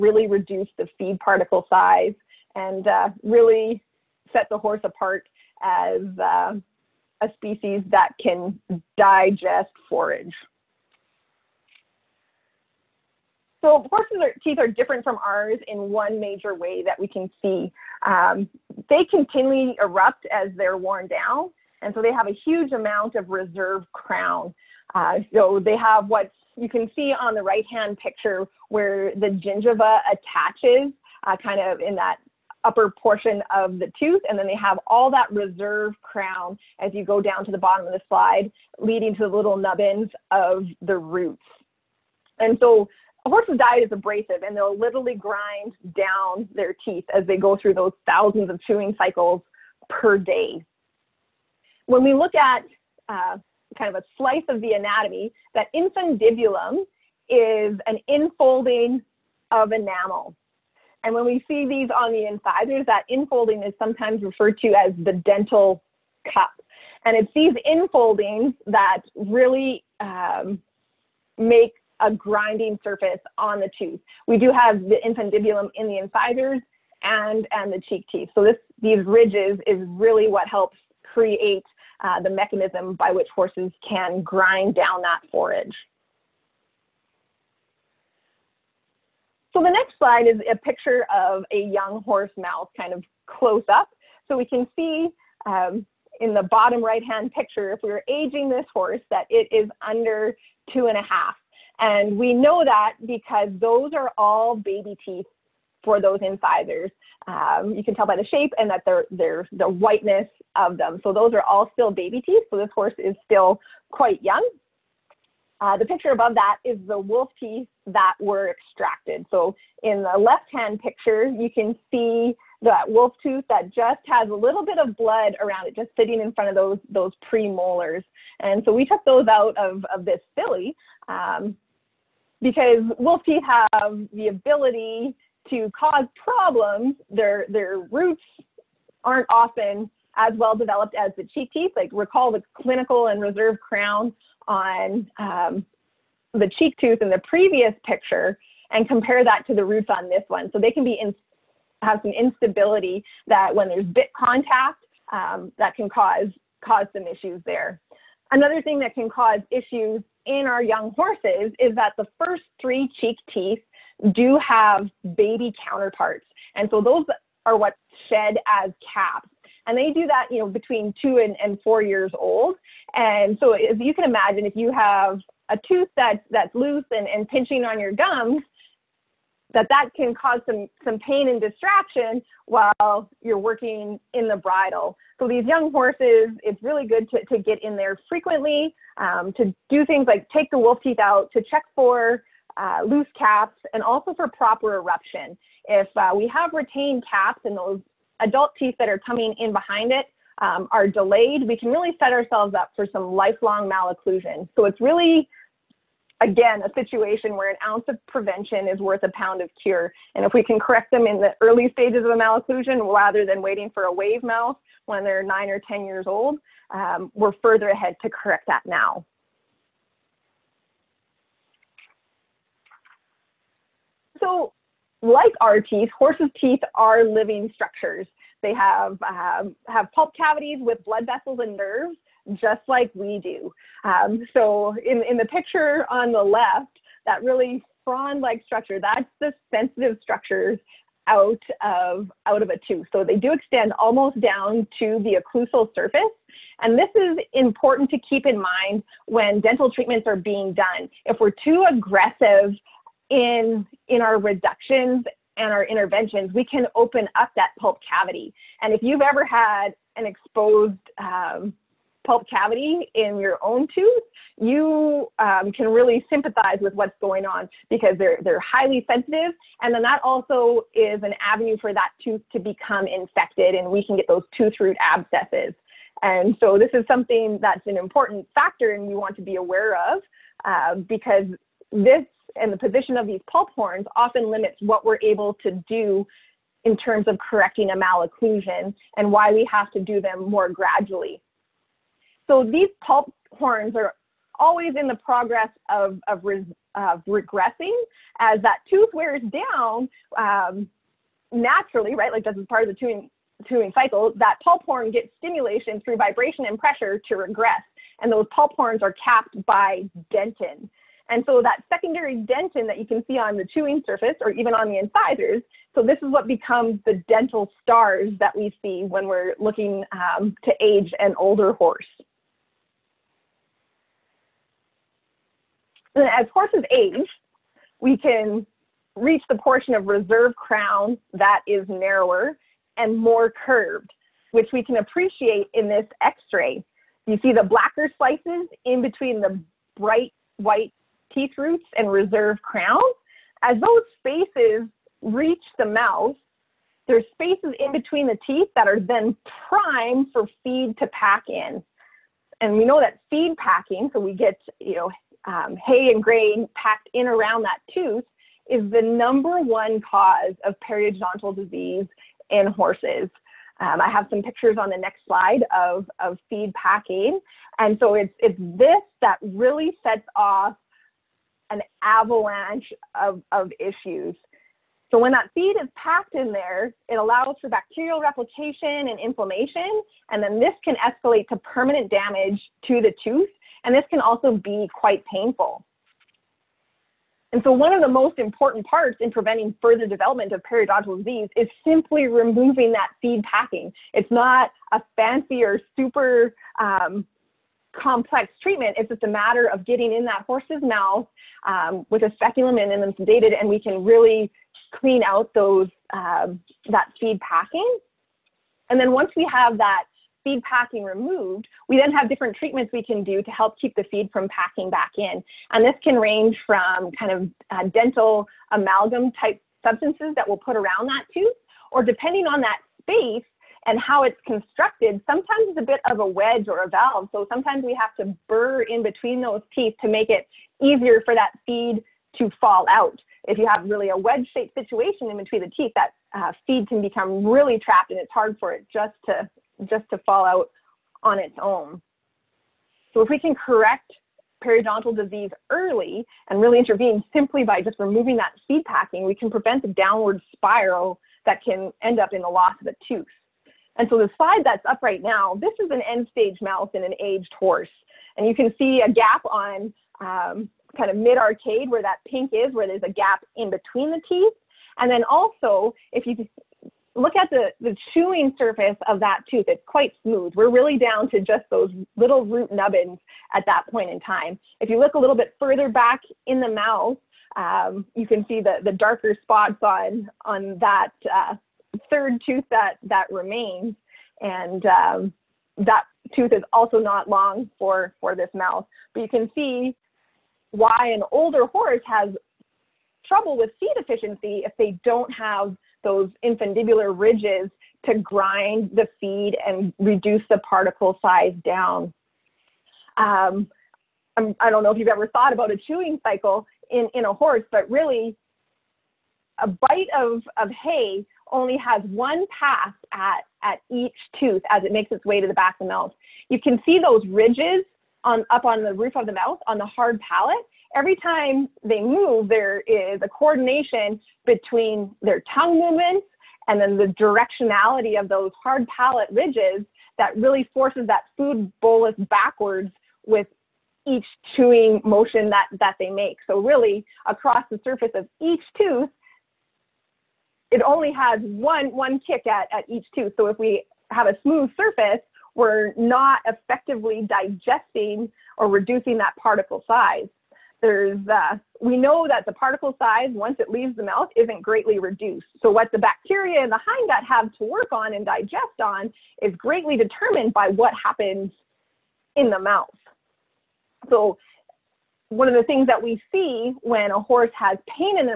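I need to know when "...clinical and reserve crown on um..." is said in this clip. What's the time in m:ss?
2:22.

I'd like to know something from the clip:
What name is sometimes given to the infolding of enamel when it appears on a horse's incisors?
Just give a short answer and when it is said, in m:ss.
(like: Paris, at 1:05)
Dental cup, at 1:05.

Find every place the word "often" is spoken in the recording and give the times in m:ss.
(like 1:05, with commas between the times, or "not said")
2:19, 4:43.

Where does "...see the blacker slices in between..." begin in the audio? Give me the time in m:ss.
5:37.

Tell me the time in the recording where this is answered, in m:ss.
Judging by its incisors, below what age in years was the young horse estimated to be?
1:40.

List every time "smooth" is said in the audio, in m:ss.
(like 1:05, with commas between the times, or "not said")
7:50, 9:04.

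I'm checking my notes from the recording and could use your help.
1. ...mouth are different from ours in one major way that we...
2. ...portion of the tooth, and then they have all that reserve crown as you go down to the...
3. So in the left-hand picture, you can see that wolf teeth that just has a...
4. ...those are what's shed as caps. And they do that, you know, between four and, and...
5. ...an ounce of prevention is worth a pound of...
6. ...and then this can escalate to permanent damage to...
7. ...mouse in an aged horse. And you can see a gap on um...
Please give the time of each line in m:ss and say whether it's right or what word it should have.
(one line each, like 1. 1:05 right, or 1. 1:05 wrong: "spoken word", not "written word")
1. 0:14 wrong: "teeth", not "mouth"
2. 0:32 right
3. 1:59 wrong: "tooth", not "teeth"
4. 2:46 wrong: "two", not "four"
5. 3:27 right
6. 6:20 right
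7. 7:36 right.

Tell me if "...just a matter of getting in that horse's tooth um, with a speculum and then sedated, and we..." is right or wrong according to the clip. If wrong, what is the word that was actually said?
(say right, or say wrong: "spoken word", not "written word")
wrong: "mouth", not "tooth".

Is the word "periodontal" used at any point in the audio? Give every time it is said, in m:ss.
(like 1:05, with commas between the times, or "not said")
6:00, 6:30, 7:24.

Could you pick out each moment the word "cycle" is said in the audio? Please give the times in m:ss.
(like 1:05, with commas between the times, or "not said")
0:48, 5:03, 8:26.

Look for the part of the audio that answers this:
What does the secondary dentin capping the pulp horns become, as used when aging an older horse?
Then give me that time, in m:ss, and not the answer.
5:17.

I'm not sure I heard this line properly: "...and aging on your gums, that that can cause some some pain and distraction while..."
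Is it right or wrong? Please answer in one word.
wrong.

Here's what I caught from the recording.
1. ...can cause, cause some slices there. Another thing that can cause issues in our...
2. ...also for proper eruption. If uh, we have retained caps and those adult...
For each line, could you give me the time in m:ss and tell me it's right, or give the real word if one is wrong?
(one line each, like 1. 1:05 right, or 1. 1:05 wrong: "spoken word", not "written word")
1. 2:35 wrong: "issues", not "slices"
2. 3:13 right.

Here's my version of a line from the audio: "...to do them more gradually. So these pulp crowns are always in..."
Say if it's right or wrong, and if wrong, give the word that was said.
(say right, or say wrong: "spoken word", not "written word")
wrong: "horns", not "crowns".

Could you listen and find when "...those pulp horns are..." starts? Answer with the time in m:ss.
5:08.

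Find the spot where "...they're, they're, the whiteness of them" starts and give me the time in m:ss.
1:48.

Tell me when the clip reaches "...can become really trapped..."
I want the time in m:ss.
7:16.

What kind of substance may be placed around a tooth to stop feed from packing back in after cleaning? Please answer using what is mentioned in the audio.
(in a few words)
Dental amalgam.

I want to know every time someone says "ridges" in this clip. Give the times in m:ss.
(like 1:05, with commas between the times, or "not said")
1:19, 8:16, 8:37, 8:49.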